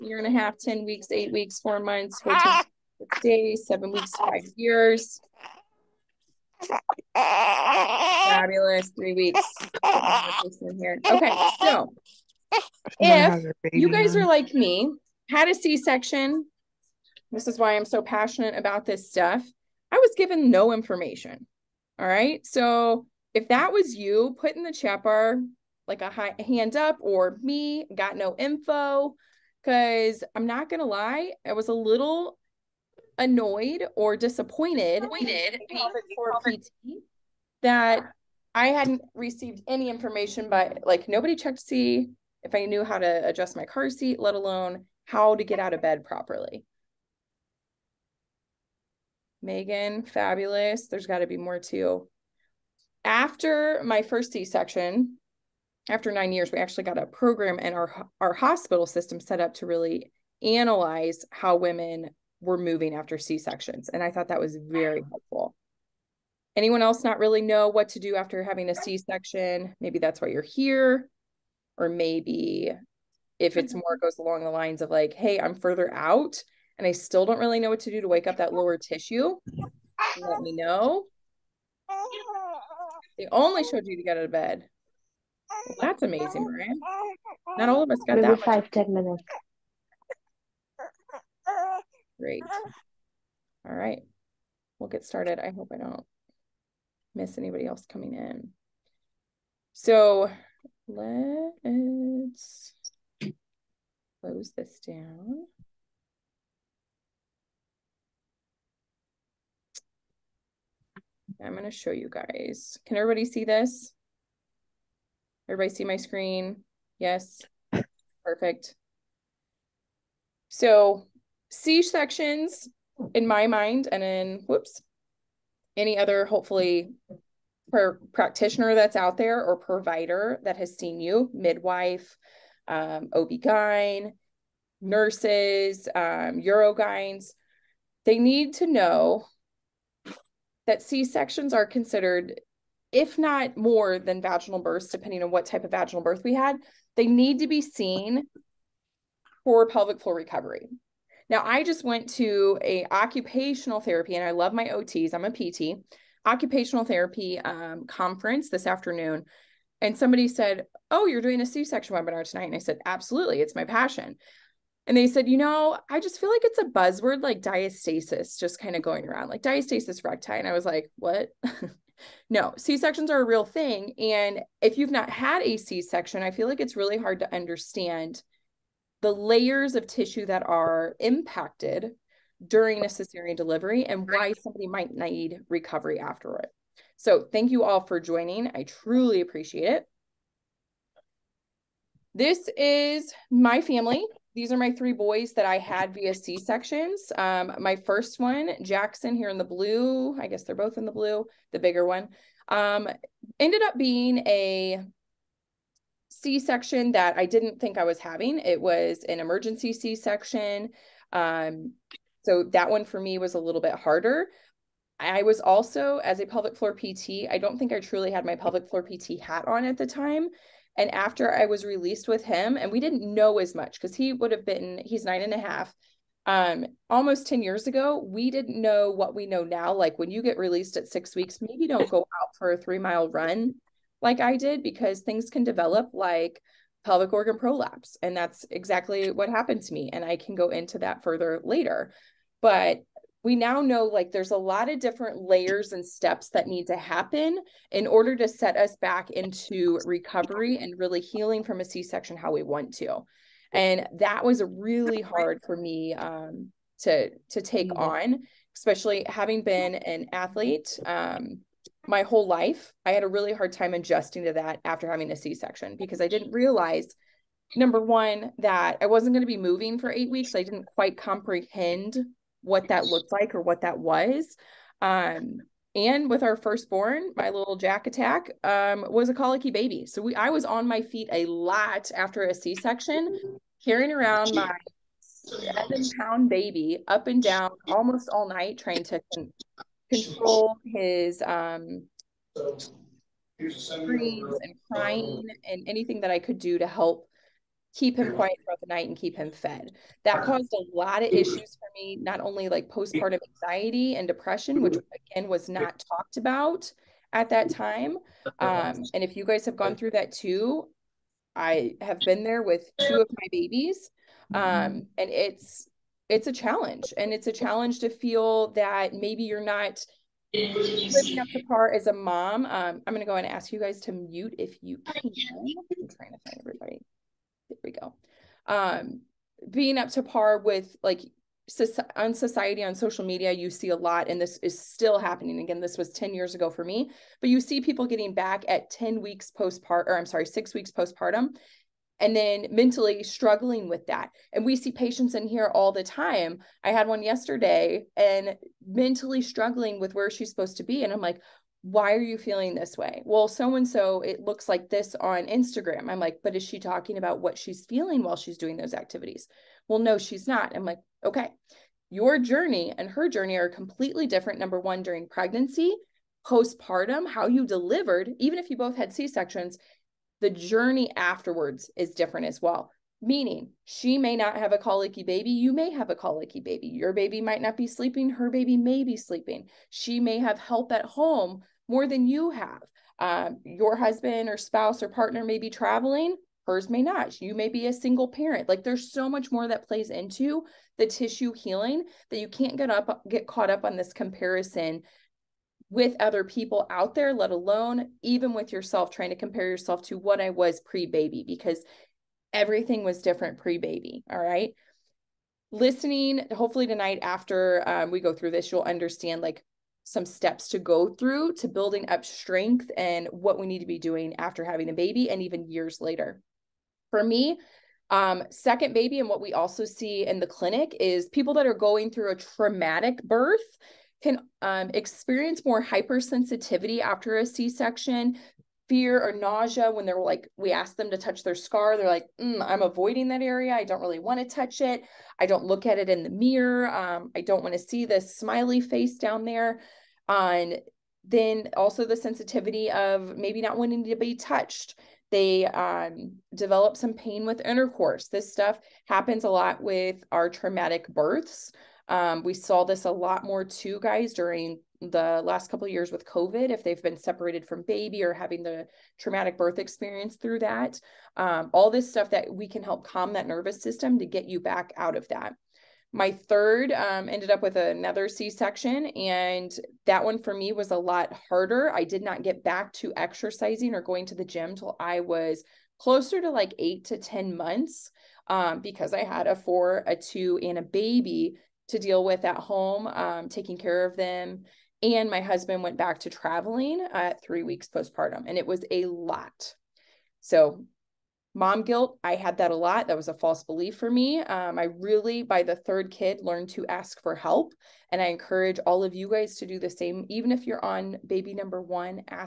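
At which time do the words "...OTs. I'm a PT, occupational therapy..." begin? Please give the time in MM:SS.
02:34.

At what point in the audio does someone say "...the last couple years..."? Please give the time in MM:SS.
07:34.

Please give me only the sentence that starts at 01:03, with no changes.
And I thought that was very helpful.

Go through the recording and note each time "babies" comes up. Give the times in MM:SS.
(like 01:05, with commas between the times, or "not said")
05:13.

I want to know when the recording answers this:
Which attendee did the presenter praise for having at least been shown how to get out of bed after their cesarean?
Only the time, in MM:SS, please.
01:26.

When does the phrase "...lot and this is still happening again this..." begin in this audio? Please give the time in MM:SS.
05:33.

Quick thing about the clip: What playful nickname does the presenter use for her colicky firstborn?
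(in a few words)
Jack attack.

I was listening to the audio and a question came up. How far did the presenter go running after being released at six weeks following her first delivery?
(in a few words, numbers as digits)
3 miles.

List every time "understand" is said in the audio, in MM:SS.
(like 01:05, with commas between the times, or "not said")
02:57, 06:48.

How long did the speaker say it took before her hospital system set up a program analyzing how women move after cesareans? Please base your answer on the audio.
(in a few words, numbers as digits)
9 years.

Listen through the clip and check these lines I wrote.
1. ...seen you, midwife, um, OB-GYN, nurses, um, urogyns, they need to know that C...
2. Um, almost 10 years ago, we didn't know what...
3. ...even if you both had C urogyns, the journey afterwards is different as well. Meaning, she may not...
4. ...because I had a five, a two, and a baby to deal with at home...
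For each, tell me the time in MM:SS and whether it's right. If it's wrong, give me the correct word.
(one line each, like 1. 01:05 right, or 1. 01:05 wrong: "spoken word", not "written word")
1. 02:10 right
2. 03:46 right
3. 06:08 wrong: "sections", not "urogyns"
4. 07:58 wrong: "four", not "five".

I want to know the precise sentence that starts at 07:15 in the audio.
I don't look at it in the mirror.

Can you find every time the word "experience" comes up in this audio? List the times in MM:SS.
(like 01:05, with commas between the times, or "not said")
07:04, 07:39.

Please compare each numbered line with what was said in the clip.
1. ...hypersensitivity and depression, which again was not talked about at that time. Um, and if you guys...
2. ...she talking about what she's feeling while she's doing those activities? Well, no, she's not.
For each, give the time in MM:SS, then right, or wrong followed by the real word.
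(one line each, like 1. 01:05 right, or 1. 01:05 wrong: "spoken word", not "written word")
1. 05:03 wrong: "anxiety", not "hypersensitivity"
2. 05:56 right.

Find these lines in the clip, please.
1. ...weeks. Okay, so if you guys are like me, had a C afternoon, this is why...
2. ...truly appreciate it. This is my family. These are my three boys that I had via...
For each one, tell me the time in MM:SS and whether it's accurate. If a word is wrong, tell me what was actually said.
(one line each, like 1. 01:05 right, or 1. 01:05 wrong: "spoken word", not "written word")
1. 00:09 wrong: "section", not "afternoon"
2. 03:08 right.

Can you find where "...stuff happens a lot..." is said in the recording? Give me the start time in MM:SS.
07:28.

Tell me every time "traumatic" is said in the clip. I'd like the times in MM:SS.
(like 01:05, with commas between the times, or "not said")
07:02, 07:30, 07:38.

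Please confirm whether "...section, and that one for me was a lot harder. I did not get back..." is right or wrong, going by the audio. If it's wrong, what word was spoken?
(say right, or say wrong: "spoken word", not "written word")
right.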